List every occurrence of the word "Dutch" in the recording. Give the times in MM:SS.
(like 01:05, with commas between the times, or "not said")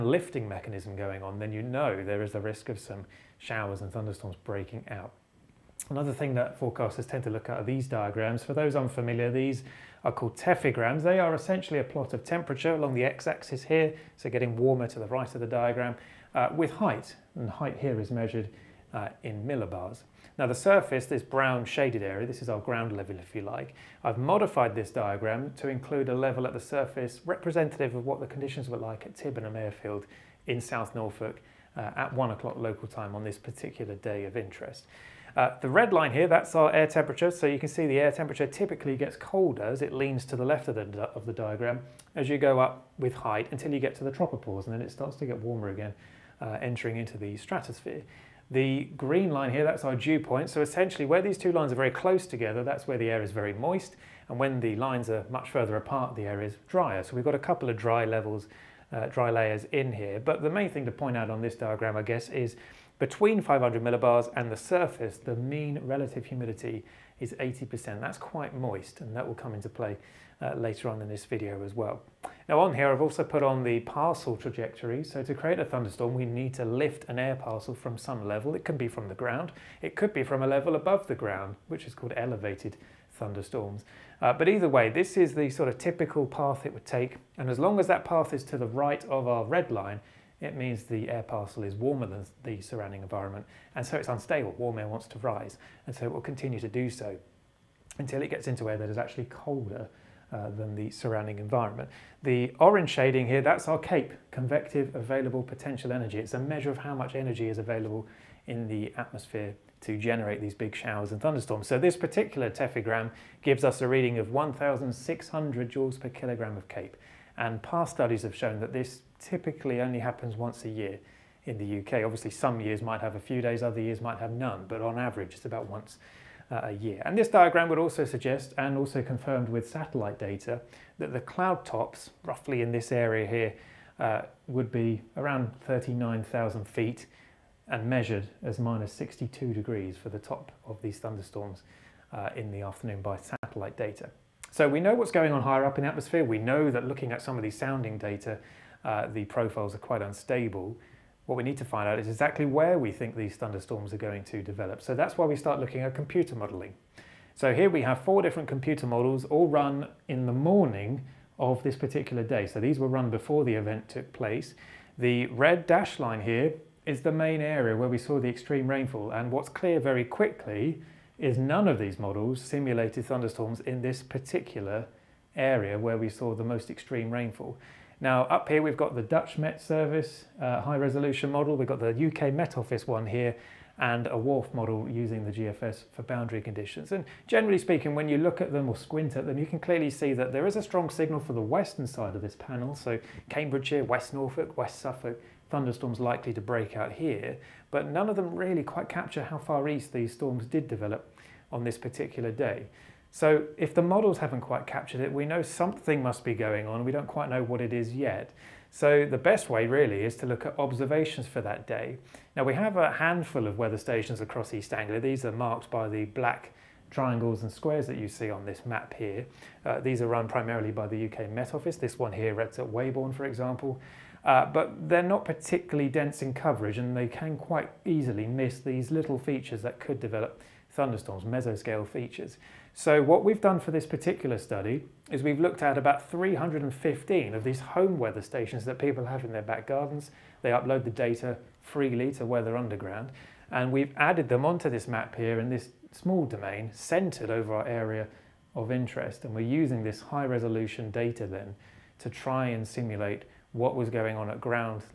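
02:59.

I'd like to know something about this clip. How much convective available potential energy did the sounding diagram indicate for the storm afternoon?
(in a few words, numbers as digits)
1,600 joules per kilogram.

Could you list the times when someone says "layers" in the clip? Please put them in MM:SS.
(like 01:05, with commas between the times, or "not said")
00:59.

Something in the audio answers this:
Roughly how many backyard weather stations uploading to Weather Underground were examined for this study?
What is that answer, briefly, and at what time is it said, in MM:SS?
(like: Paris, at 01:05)
315, at 03:56.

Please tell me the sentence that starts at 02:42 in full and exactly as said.
So these were run before the event took place.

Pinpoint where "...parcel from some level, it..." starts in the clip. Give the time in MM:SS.
01:17.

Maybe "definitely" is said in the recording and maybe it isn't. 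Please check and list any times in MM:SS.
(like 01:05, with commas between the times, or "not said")
not said.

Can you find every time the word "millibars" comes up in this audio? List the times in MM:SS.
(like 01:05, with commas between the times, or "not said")
00:19, 01:03.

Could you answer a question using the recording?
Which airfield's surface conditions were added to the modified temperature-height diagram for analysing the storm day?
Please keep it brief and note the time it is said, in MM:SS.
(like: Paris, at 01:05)
Tibenham Airfield, at 00:29.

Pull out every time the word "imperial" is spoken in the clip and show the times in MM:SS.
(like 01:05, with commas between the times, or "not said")
not said.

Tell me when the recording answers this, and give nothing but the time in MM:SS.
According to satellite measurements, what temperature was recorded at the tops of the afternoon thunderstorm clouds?
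02:18.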